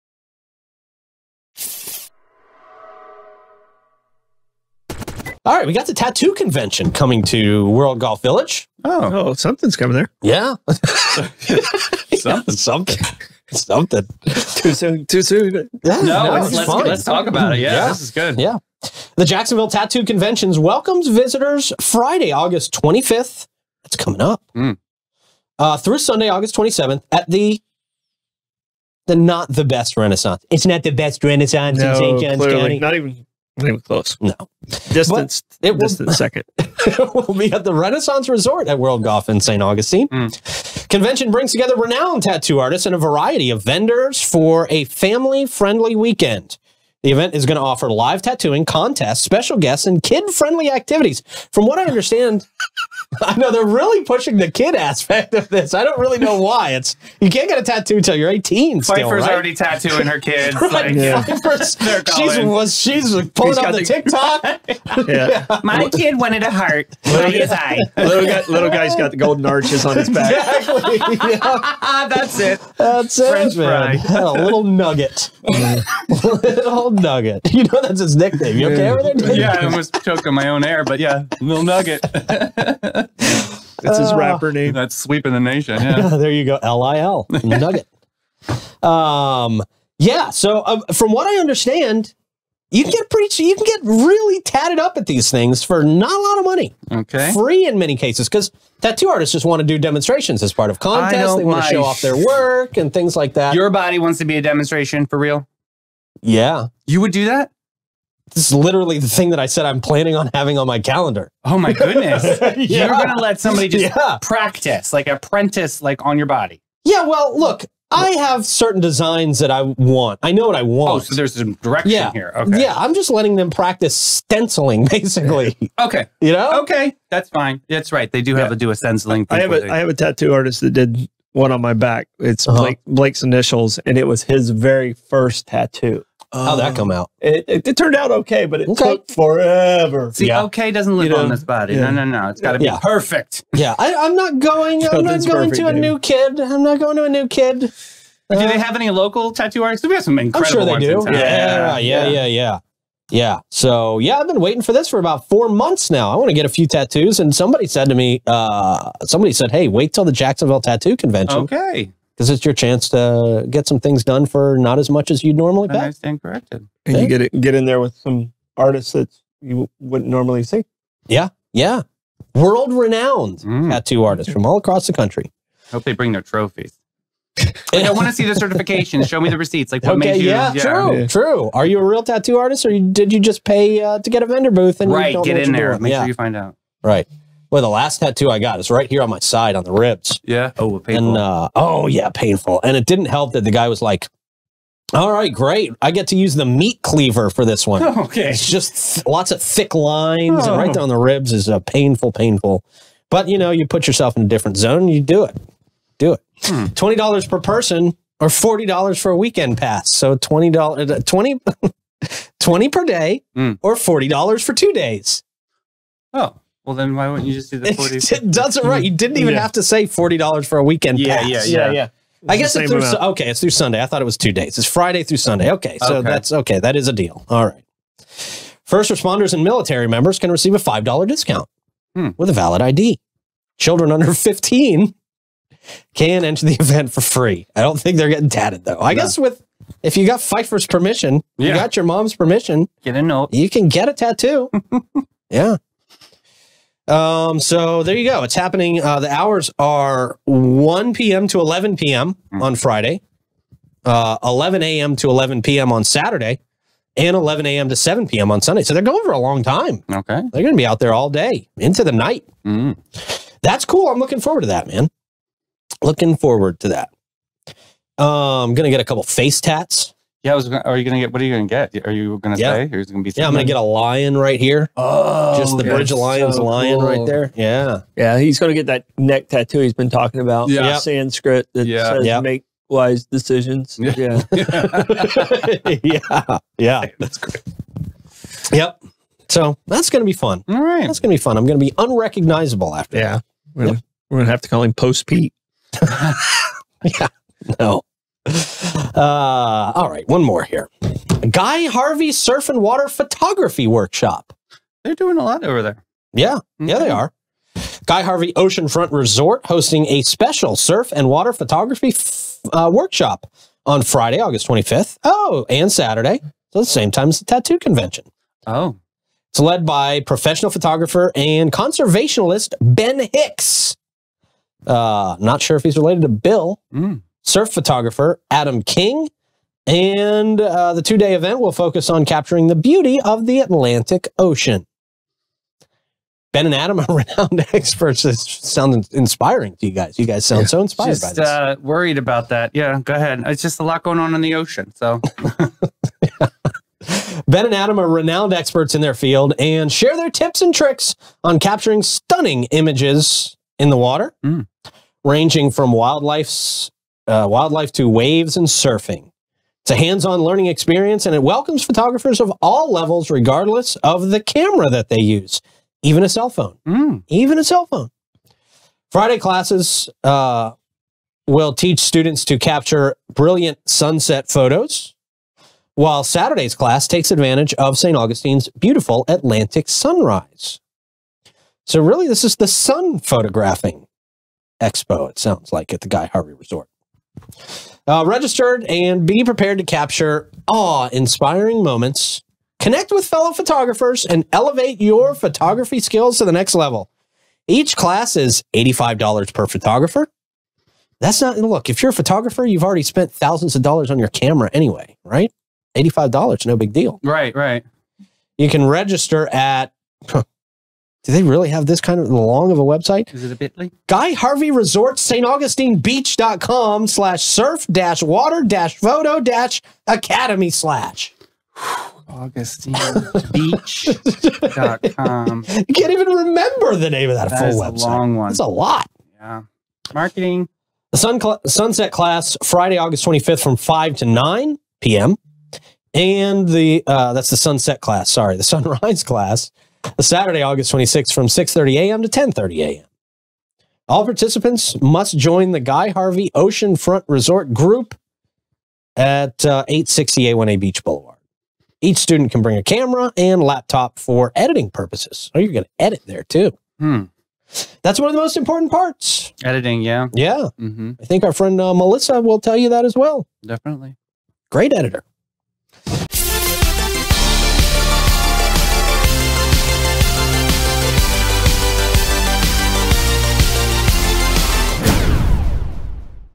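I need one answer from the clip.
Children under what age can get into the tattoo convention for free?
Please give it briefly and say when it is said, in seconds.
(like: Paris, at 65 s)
15, at 234 s.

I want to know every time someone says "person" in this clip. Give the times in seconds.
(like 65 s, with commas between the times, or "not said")
207 s.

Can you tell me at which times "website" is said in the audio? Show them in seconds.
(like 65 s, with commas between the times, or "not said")
412 s, 427 s.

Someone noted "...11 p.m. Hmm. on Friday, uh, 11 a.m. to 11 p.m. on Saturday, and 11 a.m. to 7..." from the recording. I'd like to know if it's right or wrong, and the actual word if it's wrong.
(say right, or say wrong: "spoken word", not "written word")
right.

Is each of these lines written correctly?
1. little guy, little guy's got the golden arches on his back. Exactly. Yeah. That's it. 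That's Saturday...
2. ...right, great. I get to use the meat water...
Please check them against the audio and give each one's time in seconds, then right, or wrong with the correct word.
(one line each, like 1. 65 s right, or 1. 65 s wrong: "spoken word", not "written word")
1. 67 s wrong: "French", not "Saturday"
2. 195 s wrong: "cleaver", not "water".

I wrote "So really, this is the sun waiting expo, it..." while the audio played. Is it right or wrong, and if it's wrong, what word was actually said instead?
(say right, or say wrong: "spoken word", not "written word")
wrong: "photographing", not "waiting".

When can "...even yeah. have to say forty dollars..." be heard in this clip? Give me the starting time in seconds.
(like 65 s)
219 s.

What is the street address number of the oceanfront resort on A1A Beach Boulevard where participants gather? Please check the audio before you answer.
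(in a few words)
860.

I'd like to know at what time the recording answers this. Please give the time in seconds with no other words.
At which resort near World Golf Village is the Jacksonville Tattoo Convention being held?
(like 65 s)
37 s.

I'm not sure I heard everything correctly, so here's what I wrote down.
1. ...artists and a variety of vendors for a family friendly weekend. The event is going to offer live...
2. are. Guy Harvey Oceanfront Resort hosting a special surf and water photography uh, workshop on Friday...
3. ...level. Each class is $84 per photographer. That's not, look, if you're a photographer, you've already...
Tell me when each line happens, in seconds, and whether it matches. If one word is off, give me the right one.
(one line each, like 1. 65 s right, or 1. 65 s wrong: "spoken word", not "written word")
1. 42 s right
2. 306 s right
3. 396 s wrong: "85", not "84".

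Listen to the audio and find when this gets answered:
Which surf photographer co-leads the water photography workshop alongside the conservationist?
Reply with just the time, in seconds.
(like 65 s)
328 s.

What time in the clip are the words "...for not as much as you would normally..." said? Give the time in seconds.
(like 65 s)
164 s.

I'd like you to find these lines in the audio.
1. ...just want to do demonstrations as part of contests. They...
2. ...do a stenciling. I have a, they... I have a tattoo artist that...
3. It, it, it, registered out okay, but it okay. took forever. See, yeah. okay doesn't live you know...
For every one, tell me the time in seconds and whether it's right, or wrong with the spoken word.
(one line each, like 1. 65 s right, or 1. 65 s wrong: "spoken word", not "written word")
1. 99 s right
2. 128 s right
3. 137 s wrong: "turned", not "registered".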